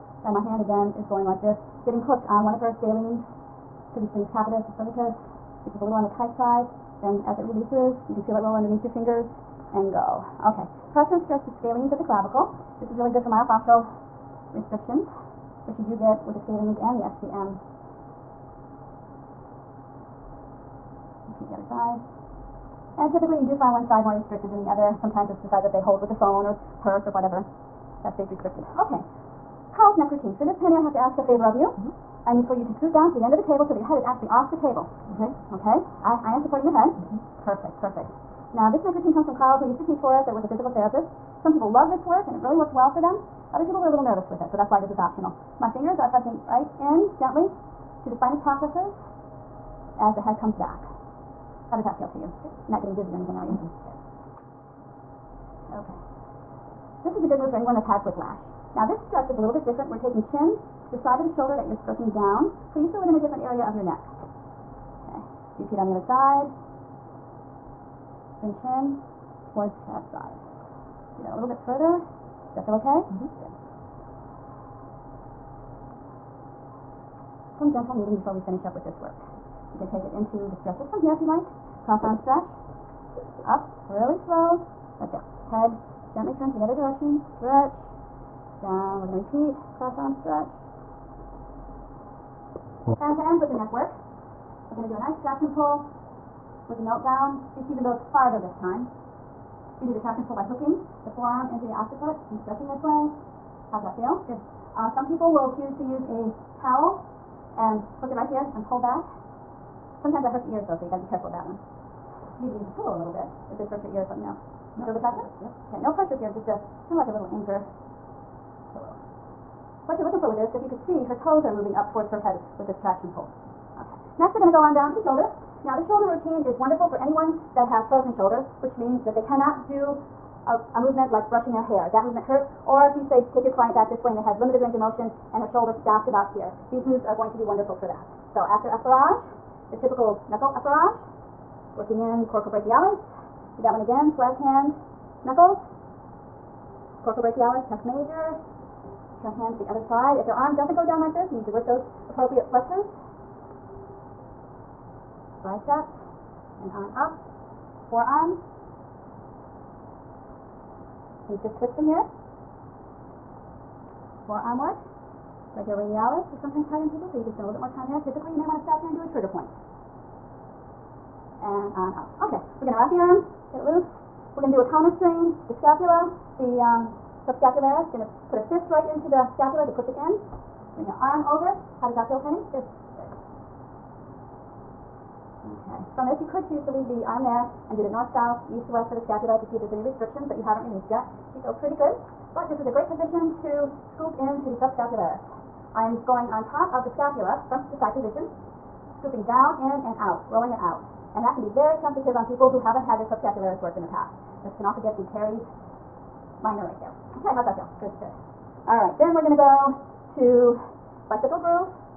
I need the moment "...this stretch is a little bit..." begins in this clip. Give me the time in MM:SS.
00:58.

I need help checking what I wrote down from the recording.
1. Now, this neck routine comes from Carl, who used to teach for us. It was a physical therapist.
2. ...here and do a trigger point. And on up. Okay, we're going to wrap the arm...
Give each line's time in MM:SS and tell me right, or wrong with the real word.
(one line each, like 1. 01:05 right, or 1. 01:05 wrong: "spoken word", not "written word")
1. 00:38 right
2. 02:48 right.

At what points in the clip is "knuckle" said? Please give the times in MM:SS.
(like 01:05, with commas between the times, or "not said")
02:20, 02:25.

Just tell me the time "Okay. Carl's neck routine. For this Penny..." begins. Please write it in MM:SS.
00:28.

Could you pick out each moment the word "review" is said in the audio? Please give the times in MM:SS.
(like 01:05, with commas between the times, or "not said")
not said.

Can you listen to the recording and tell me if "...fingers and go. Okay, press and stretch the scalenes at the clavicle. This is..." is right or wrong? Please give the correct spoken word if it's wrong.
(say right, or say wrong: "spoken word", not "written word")
right.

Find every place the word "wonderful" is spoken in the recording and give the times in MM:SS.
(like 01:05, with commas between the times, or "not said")
02:06, 02:17.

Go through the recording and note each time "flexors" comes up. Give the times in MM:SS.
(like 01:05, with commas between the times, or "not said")
02:32.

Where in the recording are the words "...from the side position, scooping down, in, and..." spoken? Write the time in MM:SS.
03:17.